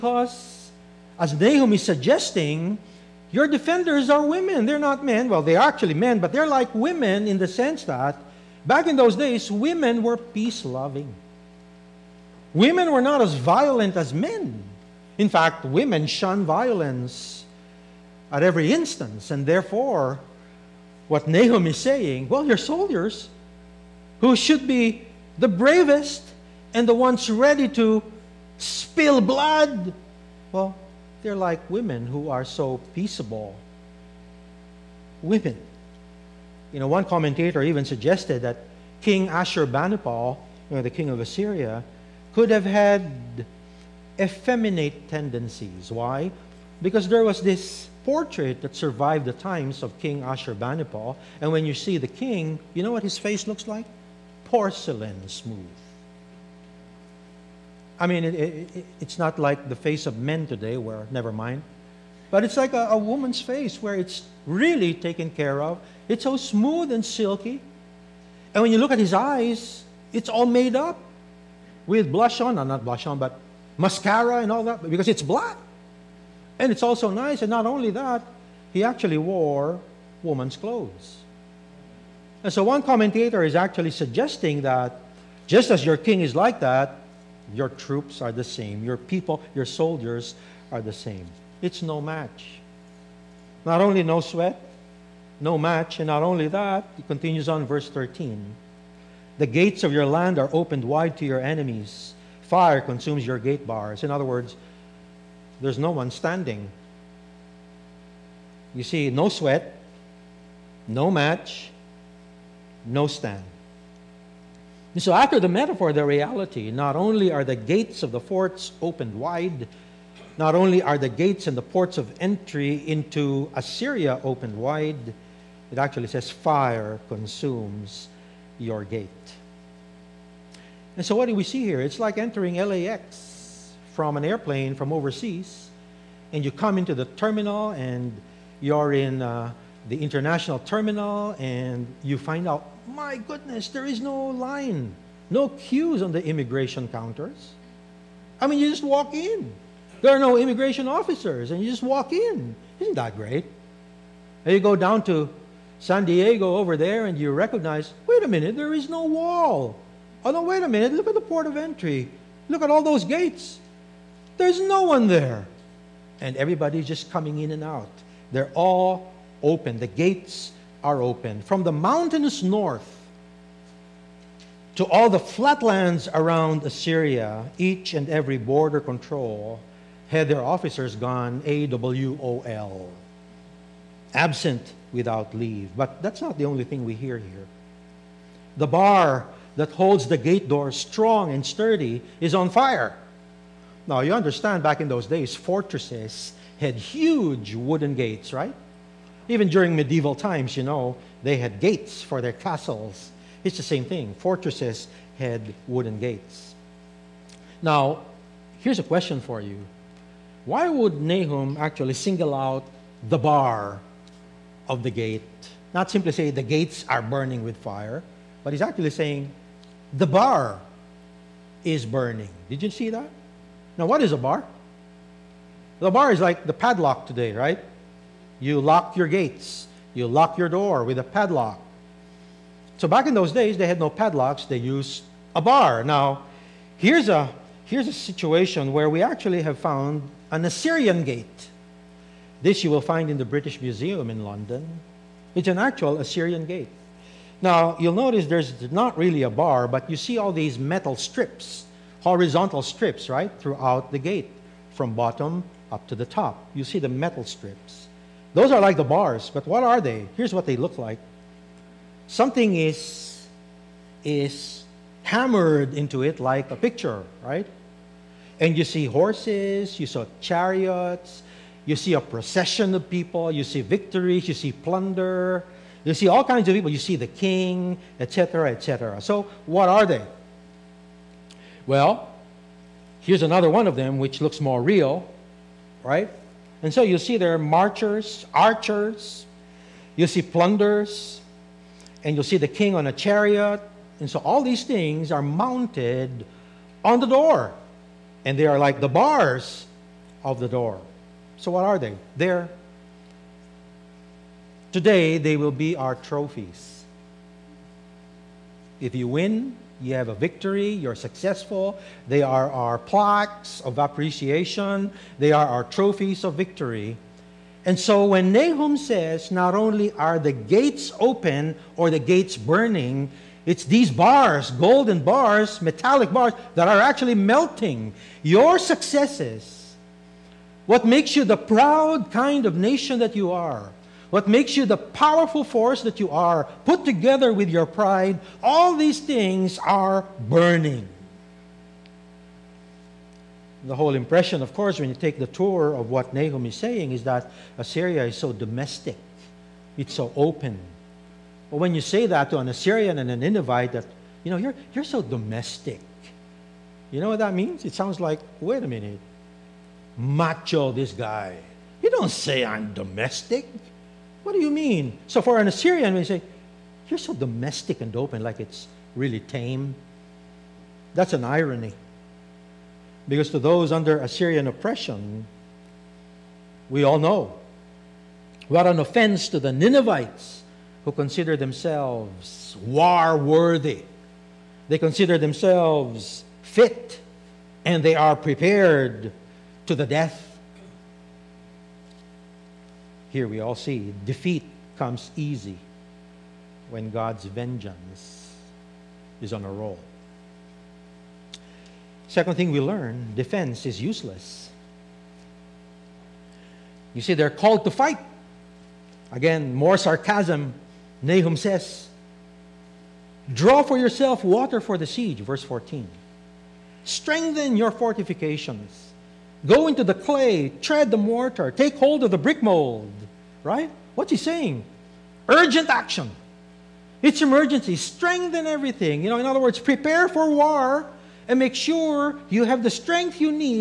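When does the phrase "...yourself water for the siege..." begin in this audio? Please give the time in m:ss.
6:53.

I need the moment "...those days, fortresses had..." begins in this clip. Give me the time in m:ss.
3:14.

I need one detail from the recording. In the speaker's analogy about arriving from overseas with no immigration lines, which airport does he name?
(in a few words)
LAX.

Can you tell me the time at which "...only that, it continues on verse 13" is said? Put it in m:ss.
1:36.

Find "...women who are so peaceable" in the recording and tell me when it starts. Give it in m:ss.
0:31.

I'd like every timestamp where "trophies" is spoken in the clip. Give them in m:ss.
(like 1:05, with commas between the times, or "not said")
5:05, 5:15.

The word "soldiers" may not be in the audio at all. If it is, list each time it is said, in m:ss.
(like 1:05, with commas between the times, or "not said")
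0:22, 1:29.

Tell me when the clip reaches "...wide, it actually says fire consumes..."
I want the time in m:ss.
2:04.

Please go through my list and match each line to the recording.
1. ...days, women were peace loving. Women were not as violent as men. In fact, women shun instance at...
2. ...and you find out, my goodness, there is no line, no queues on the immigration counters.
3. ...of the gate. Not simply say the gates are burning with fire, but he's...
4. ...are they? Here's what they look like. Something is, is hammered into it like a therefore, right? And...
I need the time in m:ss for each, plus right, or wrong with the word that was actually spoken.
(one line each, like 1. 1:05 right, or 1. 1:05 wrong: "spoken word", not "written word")
1. 0:09 wrong: "violence", not "instance"
2. 2:21 right
3. 3:34 right
4. 4:19 wrong: "picture", not "therefore".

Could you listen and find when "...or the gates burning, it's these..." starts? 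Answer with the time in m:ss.
5:21.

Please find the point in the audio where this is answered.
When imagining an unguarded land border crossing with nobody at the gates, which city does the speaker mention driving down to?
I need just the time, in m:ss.
2:35.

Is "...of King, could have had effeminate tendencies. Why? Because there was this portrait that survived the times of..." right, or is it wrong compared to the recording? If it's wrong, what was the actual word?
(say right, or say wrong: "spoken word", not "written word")
wrong: "Assyria", not "King".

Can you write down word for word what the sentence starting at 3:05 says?
But that's not the only thing we hear here.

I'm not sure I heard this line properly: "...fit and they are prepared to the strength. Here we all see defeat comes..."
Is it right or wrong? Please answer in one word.
wrong.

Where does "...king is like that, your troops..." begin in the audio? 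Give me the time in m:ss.
1:25.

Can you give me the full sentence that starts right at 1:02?
But it's like a, a woman's face where it's really taken care of.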